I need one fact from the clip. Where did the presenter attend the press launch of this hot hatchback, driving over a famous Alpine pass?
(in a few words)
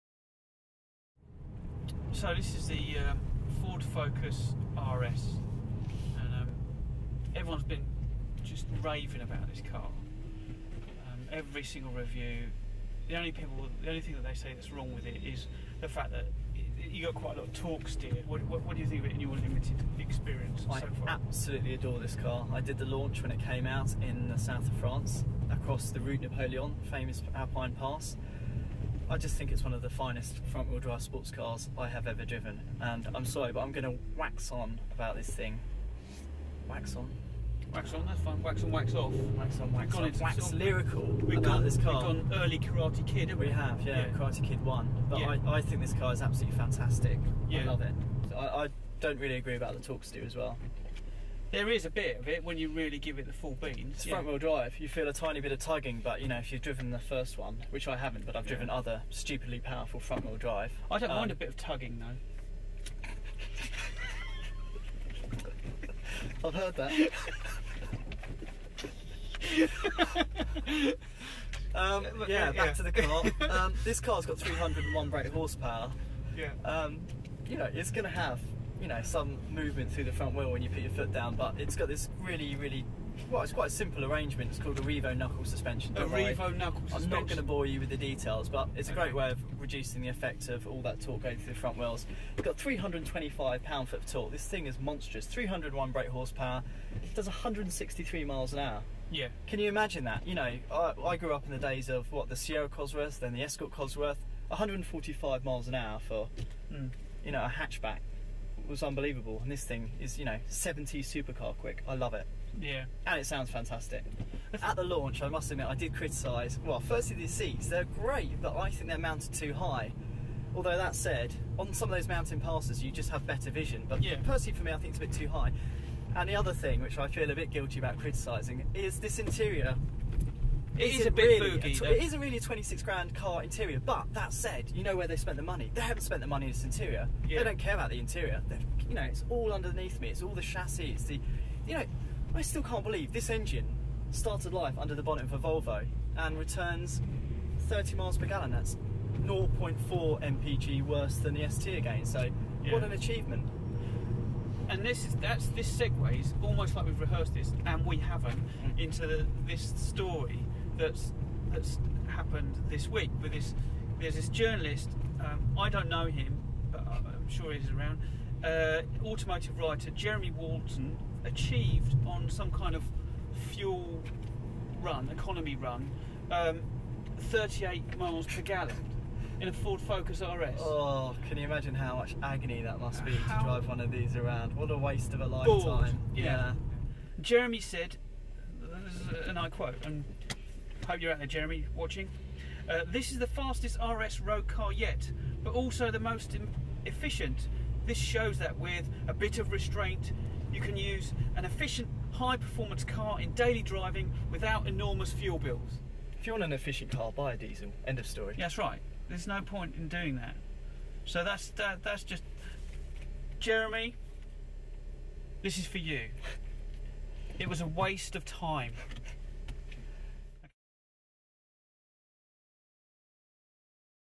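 South of France.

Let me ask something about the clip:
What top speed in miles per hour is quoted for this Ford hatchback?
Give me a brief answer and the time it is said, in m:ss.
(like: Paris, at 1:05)
163, at 1:37.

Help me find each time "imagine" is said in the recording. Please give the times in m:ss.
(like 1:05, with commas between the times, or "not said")
1:39, 3:01.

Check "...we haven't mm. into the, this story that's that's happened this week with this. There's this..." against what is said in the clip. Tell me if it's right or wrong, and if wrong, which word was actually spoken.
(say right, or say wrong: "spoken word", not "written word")
right.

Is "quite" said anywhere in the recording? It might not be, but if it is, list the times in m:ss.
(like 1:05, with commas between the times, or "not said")
0:17, 1:23.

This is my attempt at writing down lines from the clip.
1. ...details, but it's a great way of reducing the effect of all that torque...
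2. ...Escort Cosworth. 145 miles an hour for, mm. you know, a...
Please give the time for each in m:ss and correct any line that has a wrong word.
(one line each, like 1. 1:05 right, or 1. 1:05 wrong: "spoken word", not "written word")
1. 1:27 right
2. 1:43 right.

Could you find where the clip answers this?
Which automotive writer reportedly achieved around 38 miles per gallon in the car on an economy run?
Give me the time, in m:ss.
2:49.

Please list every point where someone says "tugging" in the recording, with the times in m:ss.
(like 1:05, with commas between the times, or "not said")
0:55, 1:01.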